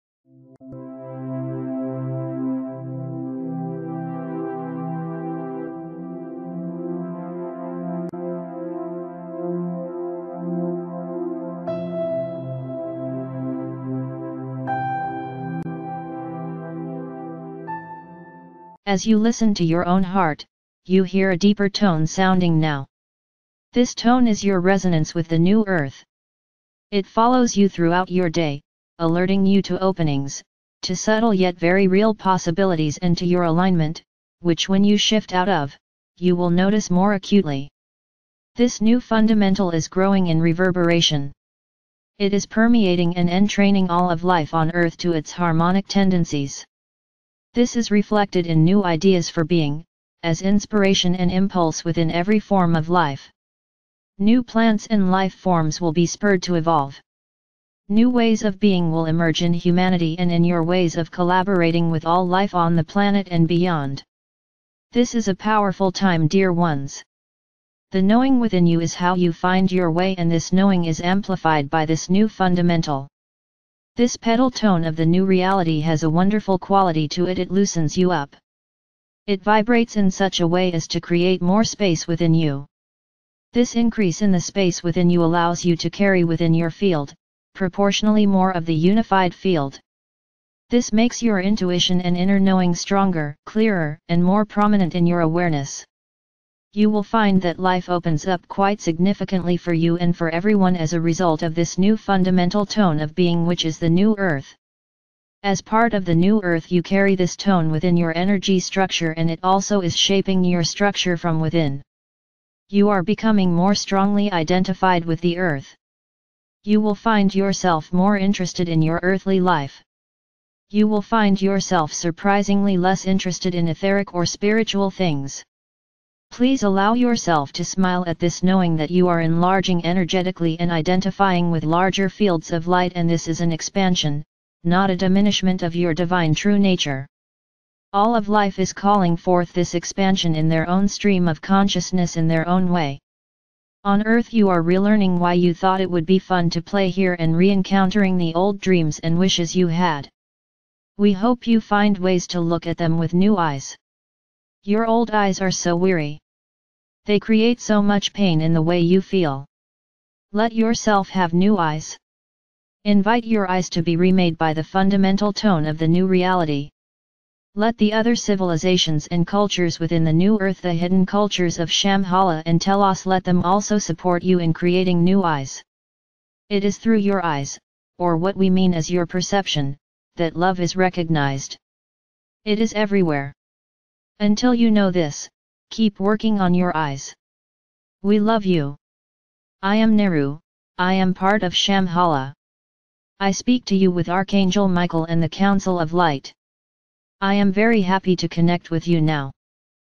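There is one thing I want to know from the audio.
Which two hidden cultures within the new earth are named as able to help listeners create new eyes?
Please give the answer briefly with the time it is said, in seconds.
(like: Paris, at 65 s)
Shambhala and Telos, at 171 s.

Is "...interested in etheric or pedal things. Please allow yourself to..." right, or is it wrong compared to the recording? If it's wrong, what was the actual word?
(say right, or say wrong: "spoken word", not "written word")
wrong: "spiritual", not "pedal".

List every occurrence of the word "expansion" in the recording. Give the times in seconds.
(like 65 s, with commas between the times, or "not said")
133 s, 139 s.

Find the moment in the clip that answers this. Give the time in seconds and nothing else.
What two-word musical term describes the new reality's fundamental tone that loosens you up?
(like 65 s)
74 s.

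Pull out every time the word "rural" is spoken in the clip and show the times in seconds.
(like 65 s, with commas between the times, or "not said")
not said.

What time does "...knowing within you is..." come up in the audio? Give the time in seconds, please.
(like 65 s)
68 s.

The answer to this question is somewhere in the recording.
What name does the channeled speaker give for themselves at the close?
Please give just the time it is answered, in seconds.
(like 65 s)
189 s.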